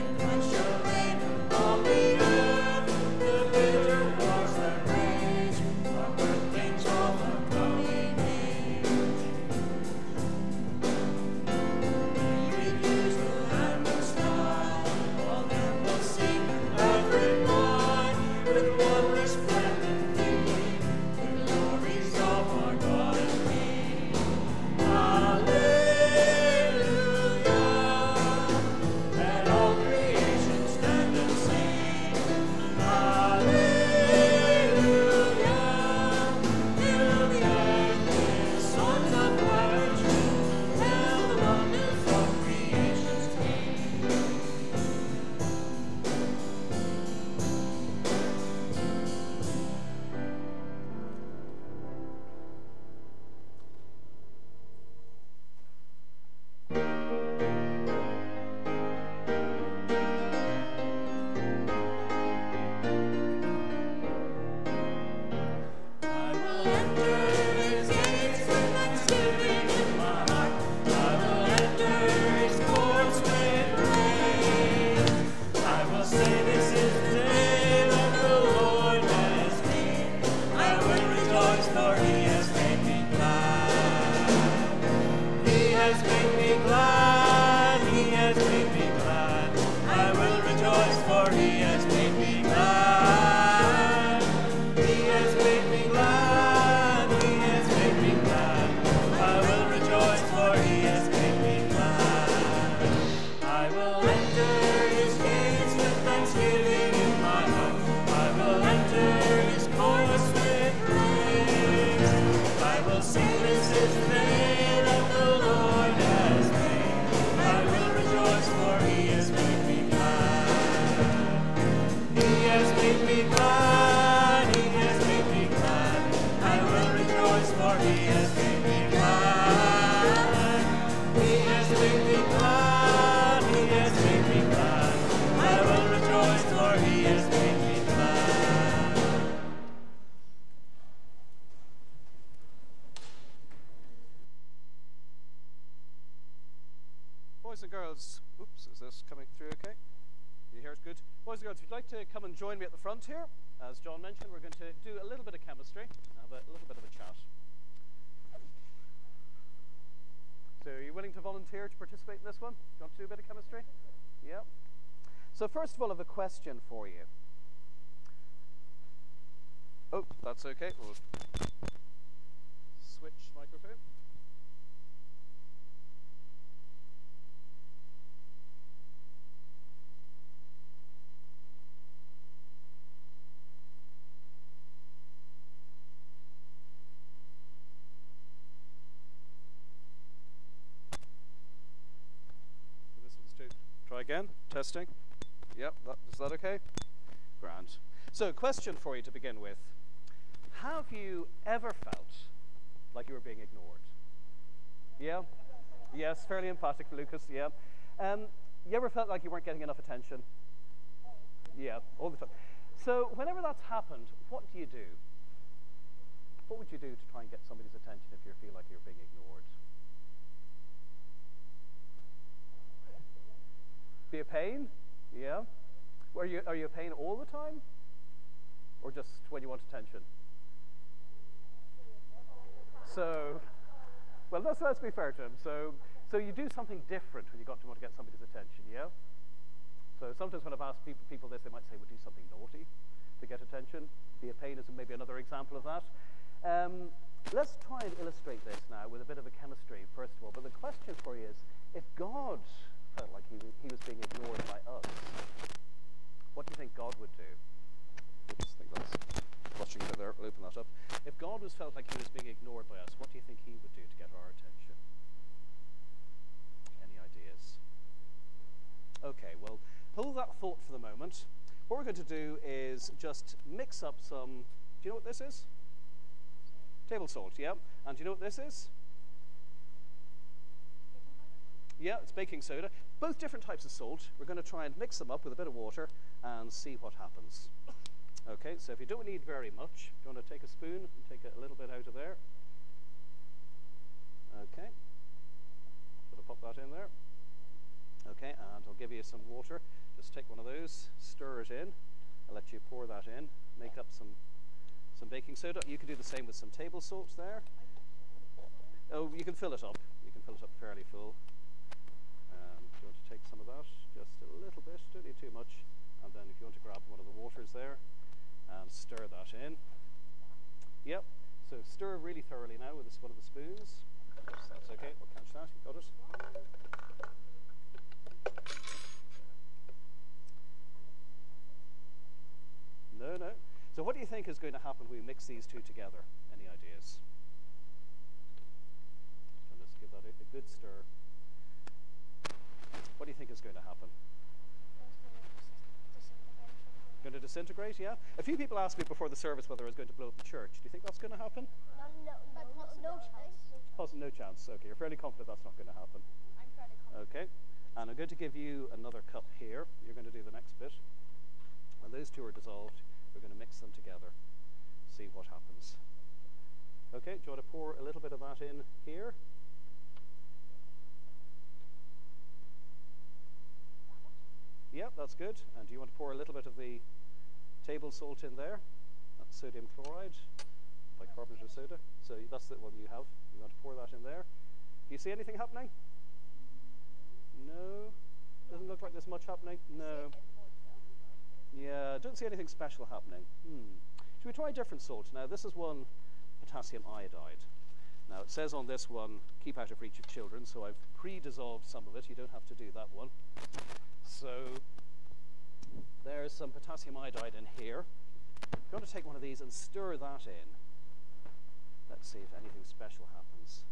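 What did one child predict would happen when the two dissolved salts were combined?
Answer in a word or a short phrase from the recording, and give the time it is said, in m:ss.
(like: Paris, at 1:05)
Disintegrate, at 5:47.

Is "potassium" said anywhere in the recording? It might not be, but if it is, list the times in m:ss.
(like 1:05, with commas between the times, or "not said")
6:36, 6:46.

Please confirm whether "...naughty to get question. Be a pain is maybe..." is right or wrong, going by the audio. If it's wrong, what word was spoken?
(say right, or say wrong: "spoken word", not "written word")
wrong: "attention", not "question".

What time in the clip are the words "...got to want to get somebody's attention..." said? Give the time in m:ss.
3:57.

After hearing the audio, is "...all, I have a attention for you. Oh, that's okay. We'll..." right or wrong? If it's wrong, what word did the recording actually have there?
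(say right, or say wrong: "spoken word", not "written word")
wrong: "question", not "attention".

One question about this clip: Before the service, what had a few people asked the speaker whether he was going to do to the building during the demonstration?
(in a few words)
Blow up the church.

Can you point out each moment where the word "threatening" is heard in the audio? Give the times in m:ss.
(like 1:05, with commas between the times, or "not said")
not said.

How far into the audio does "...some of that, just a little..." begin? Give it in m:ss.
5:13.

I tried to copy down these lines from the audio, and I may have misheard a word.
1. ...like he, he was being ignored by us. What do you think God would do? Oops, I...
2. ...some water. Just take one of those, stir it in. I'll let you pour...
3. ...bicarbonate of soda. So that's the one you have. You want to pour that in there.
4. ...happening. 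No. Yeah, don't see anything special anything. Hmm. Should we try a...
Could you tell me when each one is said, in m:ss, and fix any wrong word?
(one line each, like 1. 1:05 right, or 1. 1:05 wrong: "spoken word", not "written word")
1. 4:13 right
2. 4:59 right
3. 6:20 right
4. 6:29 wrong: "happening", not "anything".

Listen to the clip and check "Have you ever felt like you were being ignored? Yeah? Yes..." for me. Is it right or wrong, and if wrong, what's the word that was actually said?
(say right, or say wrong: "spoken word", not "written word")
right.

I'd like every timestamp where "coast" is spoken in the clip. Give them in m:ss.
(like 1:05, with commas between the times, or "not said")
not said.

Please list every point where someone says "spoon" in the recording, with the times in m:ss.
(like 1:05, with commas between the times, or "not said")
4:50, 5:23.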